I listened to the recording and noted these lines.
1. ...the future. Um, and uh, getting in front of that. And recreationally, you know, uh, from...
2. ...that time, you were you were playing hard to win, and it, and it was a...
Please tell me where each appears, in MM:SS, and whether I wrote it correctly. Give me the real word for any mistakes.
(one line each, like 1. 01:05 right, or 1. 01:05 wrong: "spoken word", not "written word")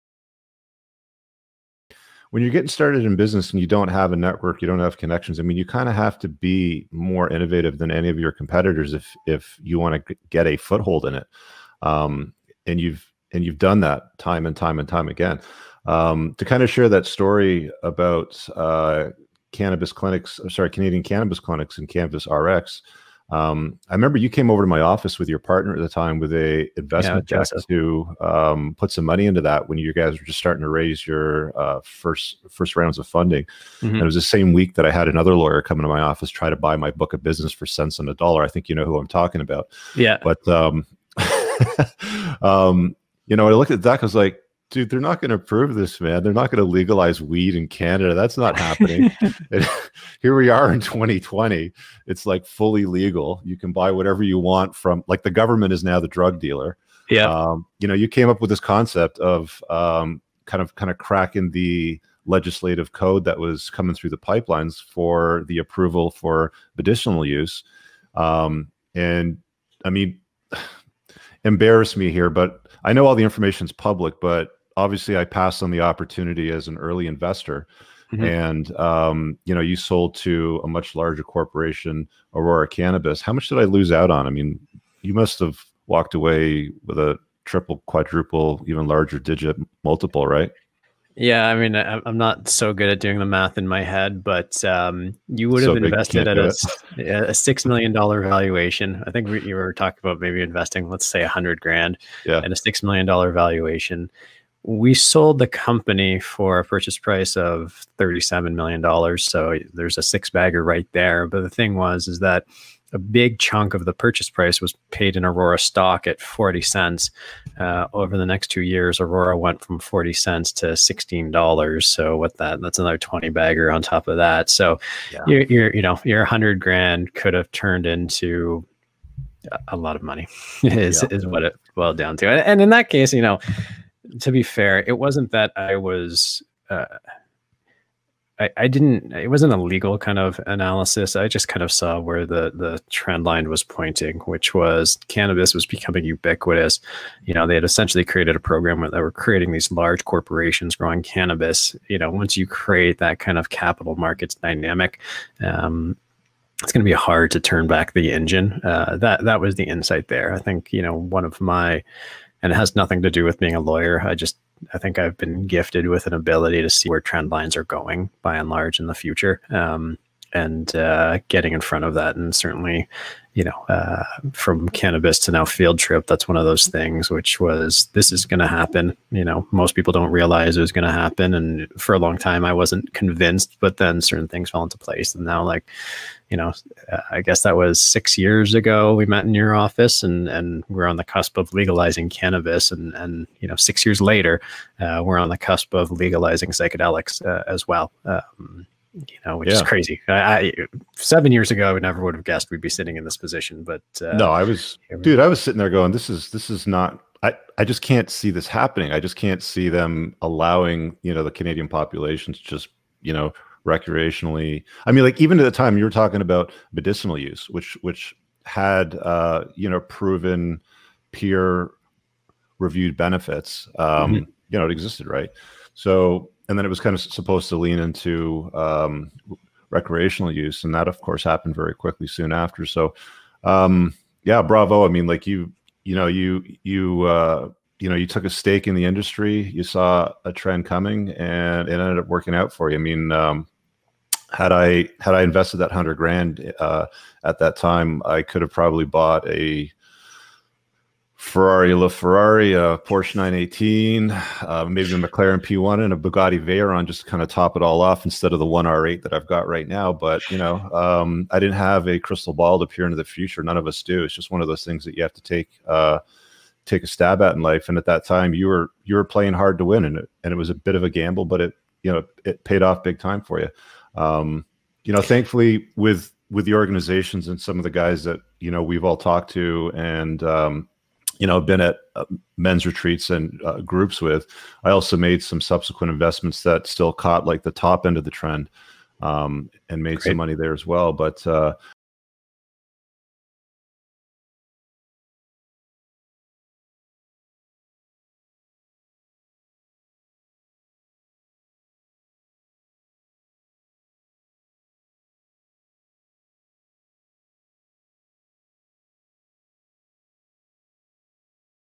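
1. 02:48 wrong: "certainly", not "recreationally"
2. 04:27 right.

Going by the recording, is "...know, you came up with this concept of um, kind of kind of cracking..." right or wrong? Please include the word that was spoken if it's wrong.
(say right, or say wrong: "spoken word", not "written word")
right.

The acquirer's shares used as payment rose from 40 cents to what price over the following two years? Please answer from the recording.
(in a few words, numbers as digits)
$16.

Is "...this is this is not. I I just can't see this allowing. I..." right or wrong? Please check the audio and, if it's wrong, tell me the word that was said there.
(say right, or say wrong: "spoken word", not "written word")
wrong: "happening", not "allowing".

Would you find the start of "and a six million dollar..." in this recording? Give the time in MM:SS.
01:42.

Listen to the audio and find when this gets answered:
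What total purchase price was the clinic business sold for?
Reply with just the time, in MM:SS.
01:47.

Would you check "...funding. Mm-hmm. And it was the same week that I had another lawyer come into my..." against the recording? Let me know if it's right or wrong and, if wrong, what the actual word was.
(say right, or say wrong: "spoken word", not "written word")
right.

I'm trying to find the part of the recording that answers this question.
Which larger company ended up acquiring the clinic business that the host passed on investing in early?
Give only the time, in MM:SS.
01:22.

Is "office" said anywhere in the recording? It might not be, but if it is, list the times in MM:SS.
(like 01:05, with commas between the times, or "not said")
00:24, 00:36, 03:09.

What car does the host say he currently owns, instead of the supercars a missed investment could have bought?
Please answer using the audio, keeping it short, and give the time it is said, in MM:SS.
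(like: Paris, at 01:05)
R8, at 04:18.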